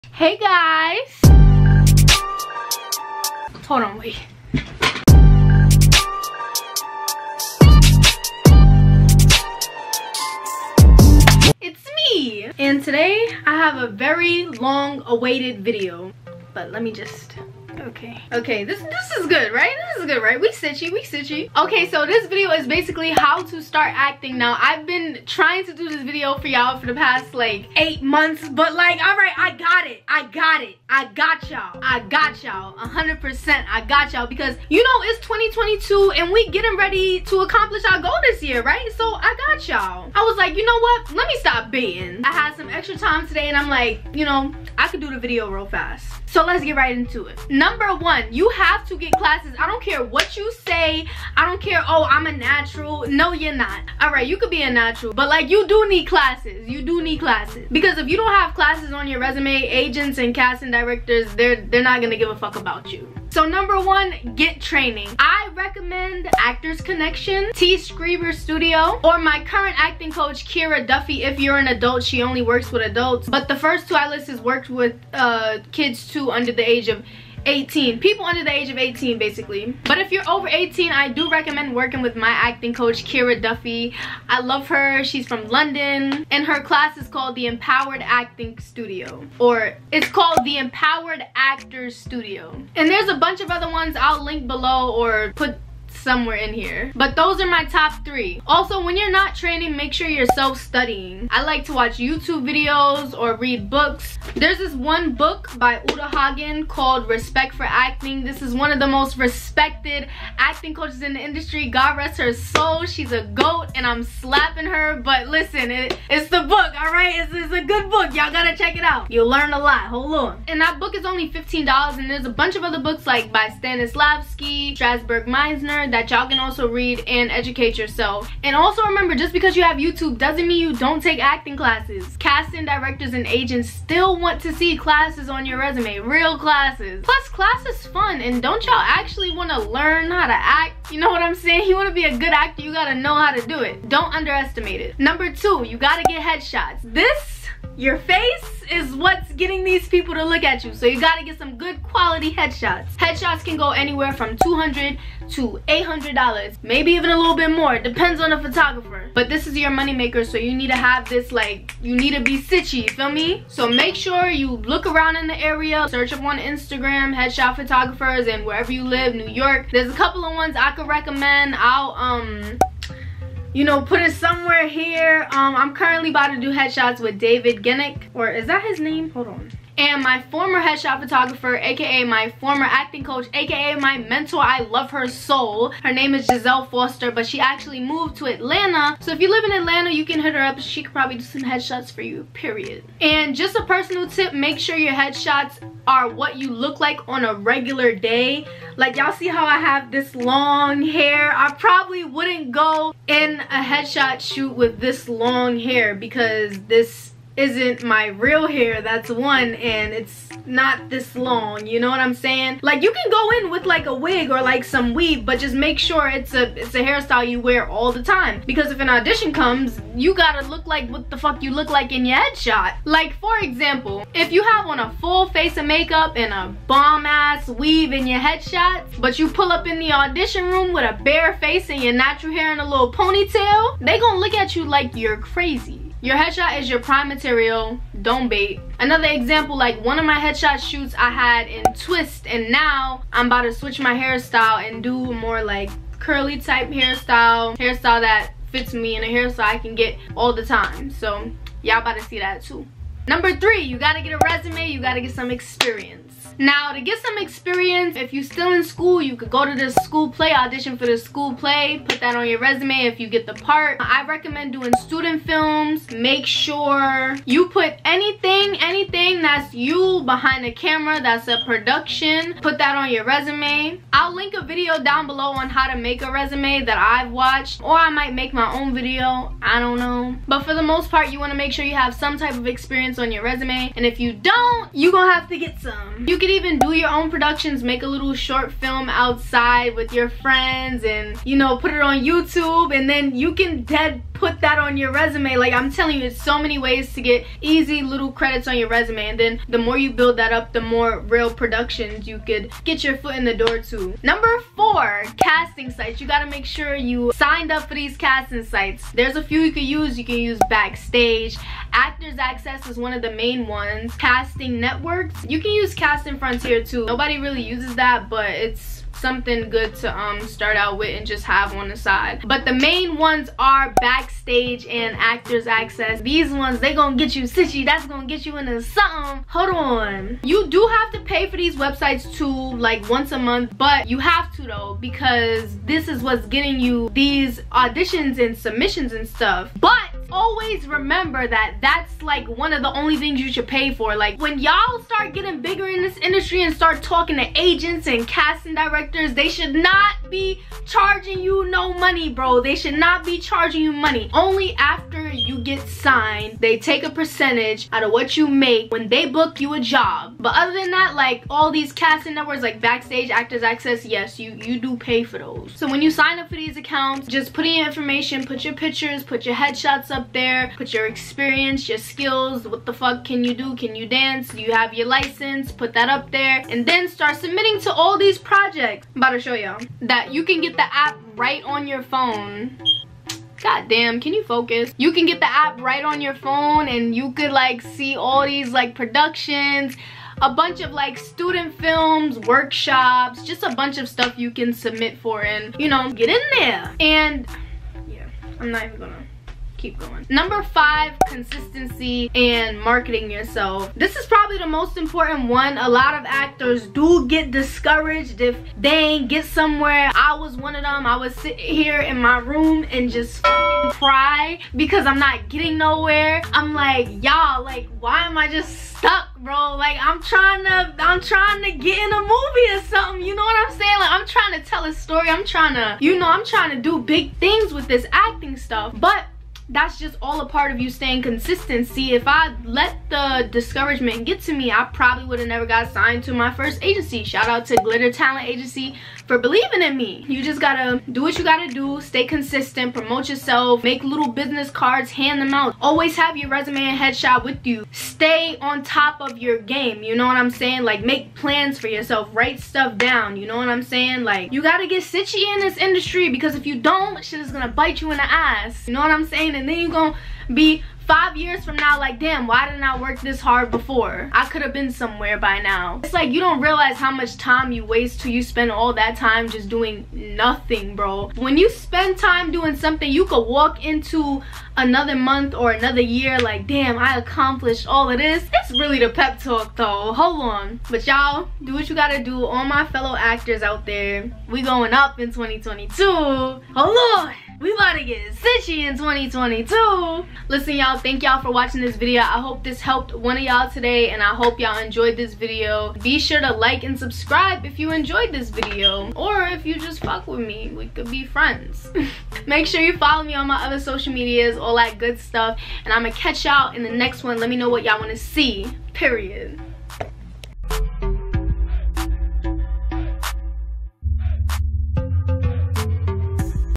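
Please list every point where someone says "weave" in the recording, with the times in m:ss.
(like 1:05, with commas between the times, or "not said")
3:34, 3:47.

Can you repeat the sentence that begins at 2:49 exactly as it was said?
There's a couple of ones I could recommend.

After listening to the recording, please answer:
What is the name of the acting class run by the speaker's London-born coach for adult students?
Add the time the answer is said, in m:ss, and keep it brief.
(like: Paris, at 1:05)
The Empowered Actors Studio, at 1:30.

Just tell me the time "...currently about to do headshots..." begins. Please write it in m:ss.
2:55.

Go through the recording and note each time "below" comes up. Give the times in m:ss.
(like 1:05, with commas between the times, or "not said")
1:34, 4:35.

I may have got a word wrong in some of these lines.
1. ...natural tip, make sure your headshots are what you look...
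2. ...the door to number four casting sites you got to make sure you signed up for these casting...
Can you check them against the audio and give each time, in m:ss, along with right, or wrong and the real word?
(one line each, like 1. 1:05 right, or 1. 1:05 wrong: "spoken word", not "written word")
1. 3:13 wrong: "personal", not "natural"
2. 5:03 right.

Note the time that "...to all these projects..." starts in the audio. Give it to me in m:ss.
6:17.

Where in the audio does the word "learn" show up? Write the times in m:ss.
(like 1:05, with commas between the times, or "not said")
1:59, 2:19.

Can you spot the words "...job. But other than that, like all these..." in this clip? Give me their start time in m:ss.
5:59.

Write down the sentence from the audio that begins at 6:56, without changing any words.
I'm like, y'all, like, why am I just stuck, bro?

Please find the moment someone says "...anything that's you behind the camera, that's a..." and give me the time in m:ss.
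4:28.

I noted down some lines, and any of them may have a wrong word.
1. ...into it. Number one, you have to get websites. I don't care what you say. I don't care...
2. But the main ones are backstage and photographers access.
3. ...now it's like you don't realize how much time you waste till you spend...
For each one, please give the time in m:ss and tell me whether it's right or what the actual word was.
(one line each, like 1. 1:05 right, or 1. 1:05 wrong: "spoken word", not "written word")
1. 0:46 wrong: "classes", not "websites"
2. 5:22 wrong: "actors", not "photographers"
3. 7:45 right.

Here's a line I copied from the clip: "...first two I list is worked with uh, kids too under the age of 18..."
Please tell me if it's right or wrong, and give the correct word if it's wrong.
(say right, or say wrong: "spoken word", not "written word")
right.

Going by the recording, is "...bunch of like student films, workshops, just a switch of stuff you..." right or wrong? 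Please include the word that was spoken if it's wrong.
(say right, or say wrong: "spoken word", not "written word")
wrong: "bunch", not "switch".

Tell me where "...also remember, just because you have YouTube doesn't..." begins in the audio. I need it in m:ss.
2:08.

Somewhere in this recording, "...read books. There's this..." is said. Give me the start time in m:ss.
1:43.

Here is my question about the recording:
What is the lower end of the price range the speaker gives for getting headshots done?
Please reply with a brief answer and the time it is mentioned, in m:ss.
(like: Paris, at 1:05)
$200, at 2:34.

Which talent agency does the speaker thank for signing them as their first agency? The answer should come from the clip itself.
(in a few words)
Glitter Talent Agency.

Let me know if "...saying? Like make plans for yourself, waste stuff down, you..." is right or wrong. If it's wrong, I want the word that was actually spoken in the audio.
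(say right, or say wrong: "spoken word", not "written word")
wrong: "write", not "waste".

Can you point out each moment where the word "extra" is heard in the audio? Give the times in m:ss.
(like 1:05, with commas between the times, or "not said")
0:42.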